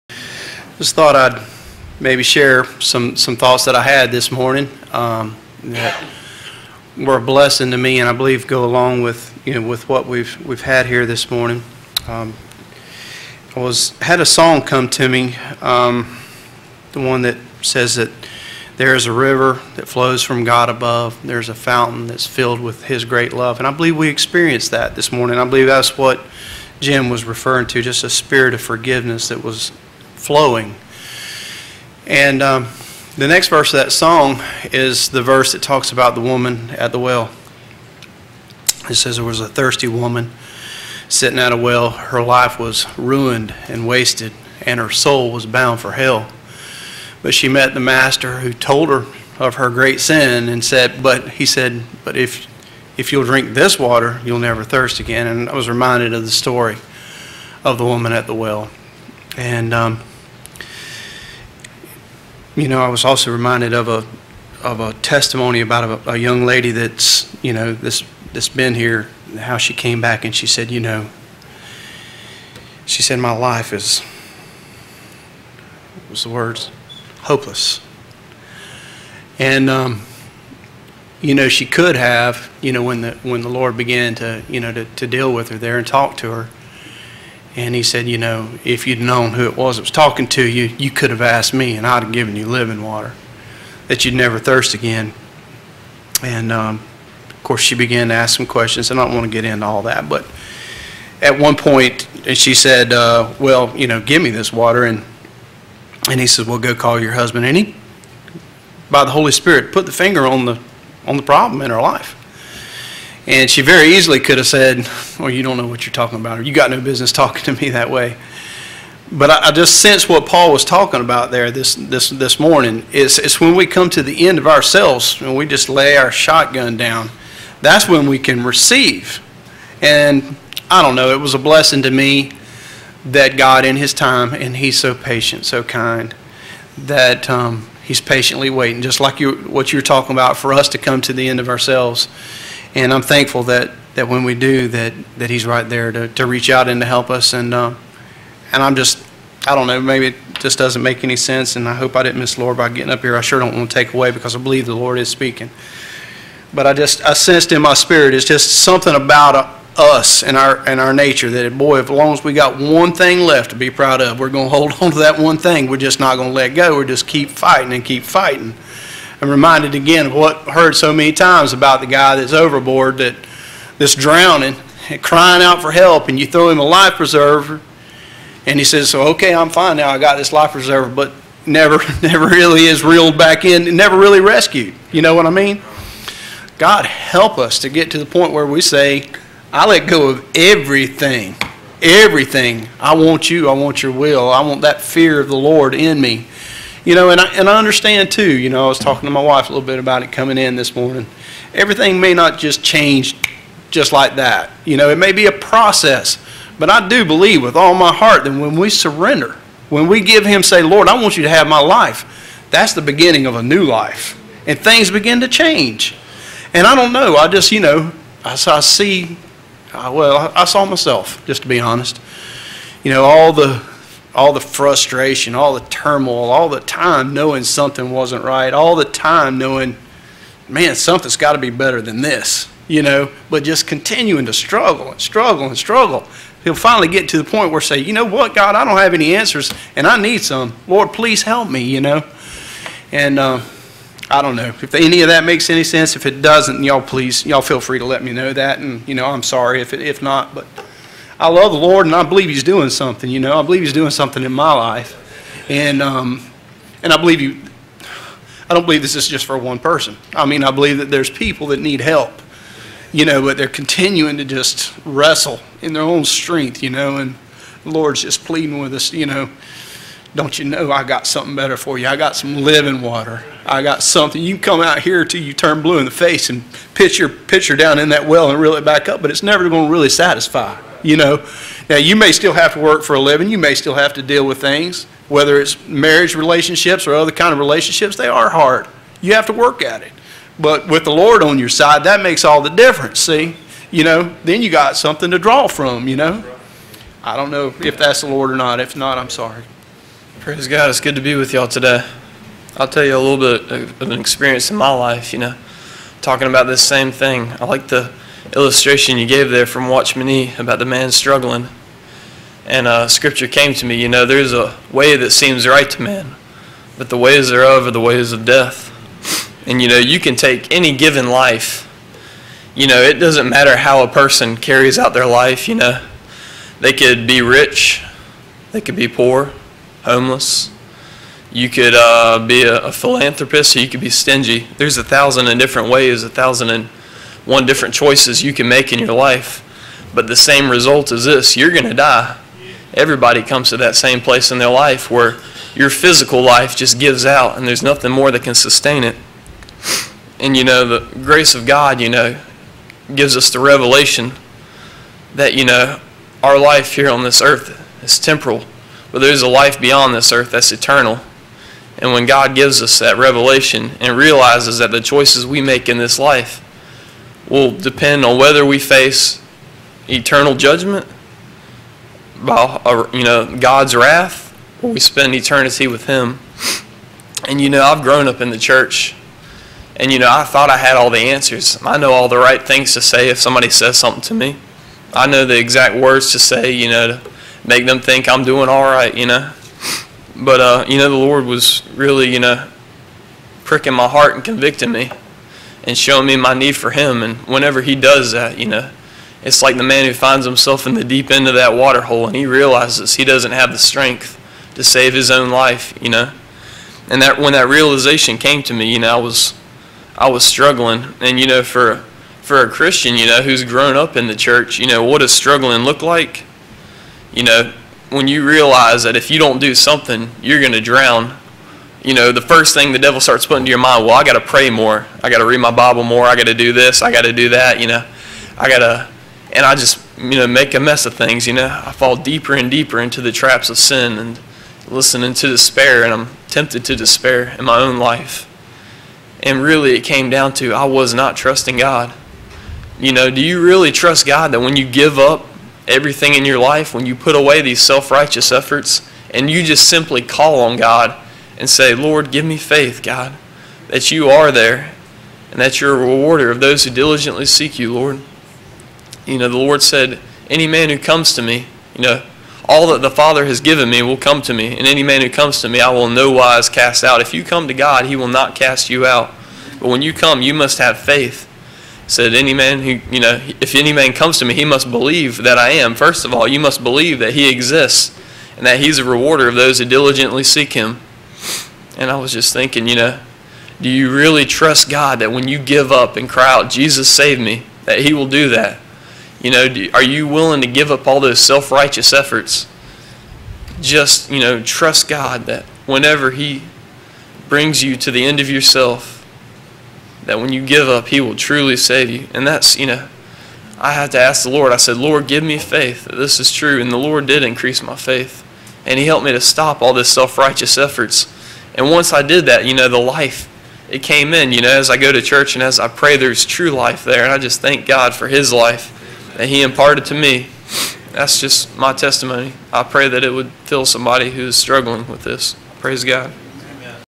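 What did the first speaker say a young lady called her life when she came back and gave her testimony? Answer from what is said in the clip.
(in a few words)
Hopeless.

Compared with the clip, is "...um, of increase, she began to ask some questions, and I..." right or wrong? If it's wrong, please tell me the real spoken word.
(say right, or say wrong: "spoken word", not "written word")
wrong: "course", not "increase".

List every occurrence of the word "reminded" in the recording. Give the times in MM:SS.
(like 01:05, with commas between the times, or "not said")
00:55, 01:03, 02:49.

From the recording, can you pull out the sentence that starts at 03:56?
He'll finally get to the point where say, you know what, God, I don't have any answers and I need some.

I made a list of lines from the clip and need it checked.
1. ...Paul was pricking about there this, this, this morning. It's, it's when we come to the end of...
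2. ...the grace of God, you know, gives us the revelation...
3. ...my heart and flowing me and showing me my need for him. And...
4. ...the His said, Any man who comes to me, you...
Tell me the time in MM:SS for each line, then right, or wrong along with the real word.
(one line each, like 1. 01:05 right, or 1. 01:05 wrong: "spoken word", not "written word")
1. 02:00 wrong: "talking", not "pricking"
2. 05:50 right
3. 06:33 wrong: "convicting", not "flowing"
4. 07:39 wrong: "Lord", not "His".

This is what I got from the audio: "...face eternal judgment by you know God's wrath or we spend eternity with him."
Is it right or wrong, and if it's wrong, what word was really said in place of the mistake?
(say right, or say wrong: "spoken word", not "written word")
right.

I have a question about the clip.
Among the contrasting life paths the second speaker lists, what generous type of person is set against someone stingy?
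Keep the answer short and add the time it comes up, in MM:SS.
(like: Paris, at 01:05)
A philanthropist, at 05:32.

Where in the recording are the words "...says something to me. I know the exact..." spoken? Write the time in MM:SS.
06:23.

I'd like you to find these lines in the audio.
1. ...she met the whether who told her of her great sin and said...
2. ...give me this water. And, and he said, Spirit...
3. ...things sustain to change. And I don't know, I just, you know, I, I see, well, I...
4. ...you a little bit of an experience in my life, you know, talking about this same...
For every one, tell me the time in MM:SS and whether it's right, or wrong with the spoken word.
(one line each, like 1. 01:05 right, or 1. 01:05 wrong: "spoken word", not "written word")
1. 00:47 wrong: "master", not "whether"
2. 01:43 wrong: "Well", not "Spirit"
3. 03:34 wrong: "begin", not "sustain"
4. 05:02 right.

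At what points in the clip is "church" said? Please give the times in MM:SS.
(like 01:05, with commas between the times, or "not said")
06:18, 06:54, 08:35.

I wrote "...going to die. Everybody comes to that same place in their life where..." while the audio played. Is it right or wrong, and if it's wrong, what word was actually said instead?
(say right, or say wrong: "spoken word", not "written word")
right.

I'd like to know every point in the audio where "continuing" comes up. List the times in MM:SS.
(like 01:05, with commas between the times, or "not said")
03:53, 04:23.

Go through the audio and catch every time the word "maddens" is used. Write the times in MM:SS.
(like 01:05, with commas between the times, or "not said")
not said.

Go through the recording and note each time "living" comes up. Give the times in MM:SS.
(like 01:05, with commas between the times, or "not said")
01:32, 04:32, 04:42.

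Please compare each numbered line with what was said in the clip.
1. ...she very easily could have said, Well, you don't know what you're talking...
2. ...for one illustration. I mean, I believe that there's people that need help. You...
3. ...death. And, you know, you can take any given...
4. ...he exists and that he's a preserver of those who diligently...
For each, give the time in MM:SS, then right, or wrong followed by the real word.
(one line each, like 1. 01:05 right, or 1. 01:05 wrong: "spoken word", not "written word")
1. 01:53 right
2. 04:19 wrong: "person", not "illustration"
3. 05:18 right
4. 07:57 wrong: "rewarder", not "preserver".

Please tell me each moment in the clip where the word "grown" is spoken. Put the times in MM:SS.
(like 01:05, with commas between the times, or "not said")
06:17, 06:53.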